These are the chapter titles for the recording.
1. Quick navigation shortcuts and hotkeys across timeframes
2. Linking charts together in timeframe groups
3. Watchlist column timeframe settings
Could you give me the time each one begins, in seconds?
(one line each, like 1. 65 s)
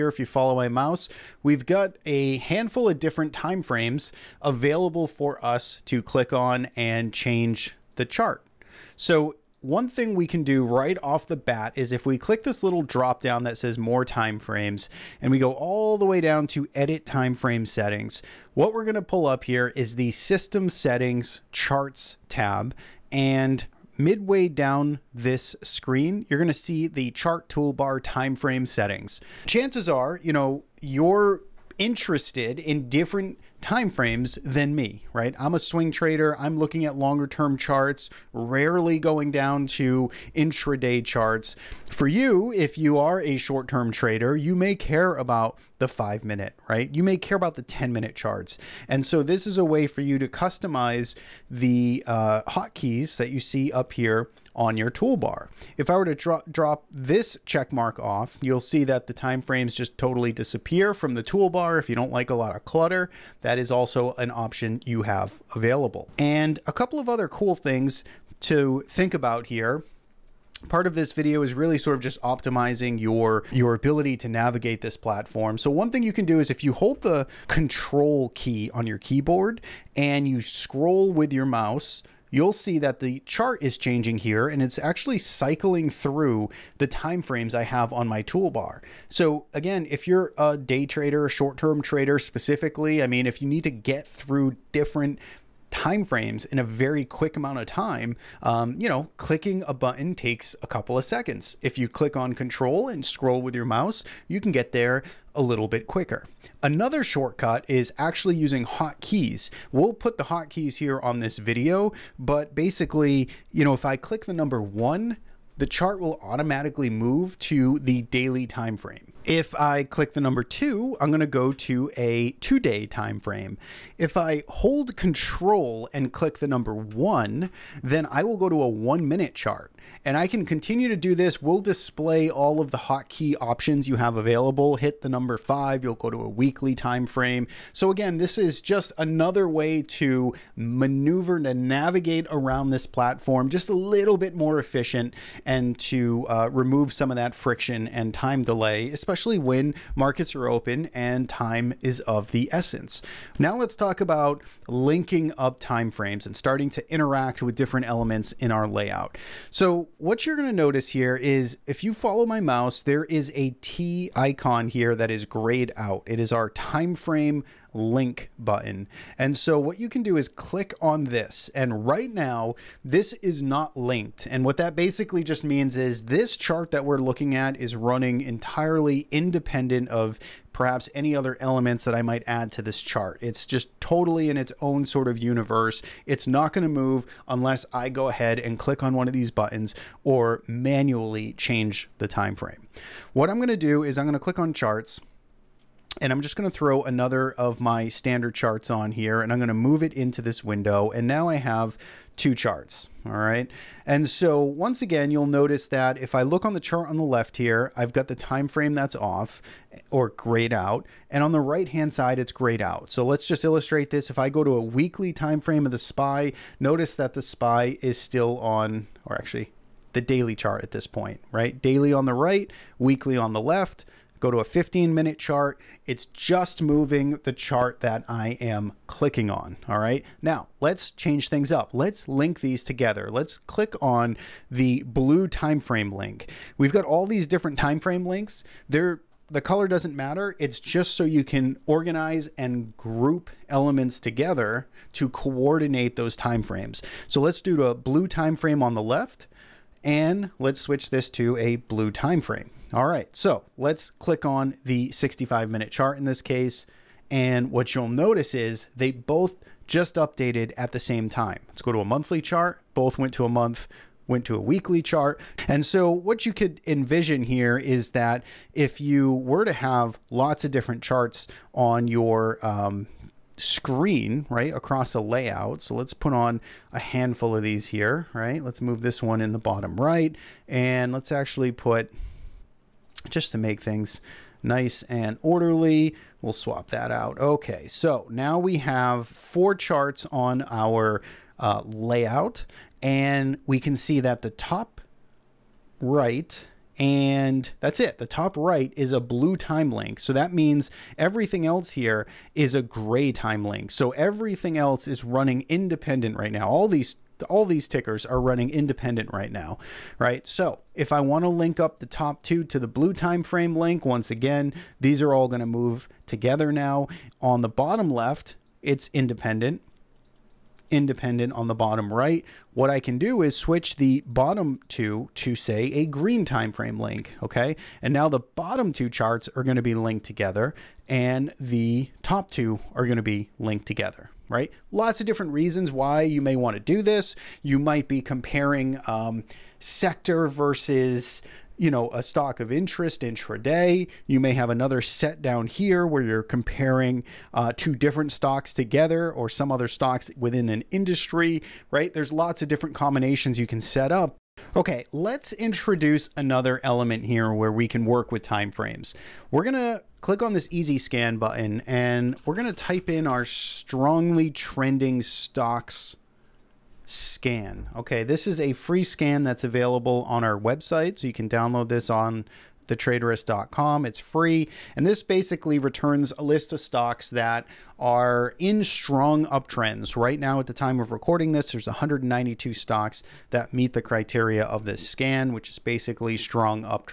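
1. 78 s
2. 153 s
3. 354 s.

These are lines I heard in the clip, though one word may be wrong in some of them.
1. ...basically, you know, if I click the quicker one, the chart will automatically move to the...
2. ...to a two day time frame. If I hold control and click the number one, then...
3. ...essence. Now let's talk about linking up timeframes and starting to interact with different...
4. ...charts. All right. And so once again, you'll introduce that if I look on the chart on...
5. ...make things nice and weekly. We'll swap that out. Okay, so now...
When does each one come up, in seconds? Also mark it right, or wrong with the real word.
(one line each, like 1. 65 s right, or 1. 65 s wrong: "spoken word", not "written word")
1. 112 s wrong: "number", not "quicker"
2. 121 s right
3. 152 s right
4. 202 s wrong: "notice", not "introduce"
5. 283 s wrong: "orderly", not "weekly".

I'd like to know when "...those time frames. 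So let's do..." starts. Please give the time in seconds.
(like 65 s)
245 s.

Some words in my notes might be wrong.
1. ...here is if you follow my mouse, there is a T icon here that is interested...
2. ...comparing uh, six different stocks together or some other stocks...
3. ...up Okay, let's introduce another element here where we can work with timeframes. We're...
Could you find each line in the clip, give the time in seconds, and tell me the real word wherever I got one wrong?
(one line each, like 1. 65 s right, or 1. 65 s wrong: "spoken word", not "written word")
1. 160 s wrong: "grayed", not "interested"
2. 346 s wrong: "two", not "six"
3. 353 s right.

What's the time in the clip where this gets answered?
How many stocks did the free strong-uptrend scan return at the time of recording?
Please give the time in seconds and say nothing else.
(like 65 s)
381 s.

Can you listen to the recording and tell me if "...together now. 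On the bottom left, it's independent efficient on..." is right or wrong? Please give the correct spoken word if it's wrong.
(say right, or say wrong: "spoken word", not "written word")
wrong: "independent", not "efficient".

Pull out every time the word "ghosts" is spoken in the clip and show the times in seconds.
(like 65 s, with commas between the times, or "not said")
not said.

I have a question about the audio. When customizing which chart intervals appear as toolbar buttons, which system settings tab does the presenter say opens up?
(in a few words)
Charts tab.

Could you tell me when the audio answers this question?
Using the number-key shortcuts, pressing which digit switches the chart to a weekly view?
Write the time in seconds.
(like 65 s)
135 s.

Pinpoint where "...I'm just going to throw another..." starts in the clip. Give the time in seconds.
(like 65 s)
196 s.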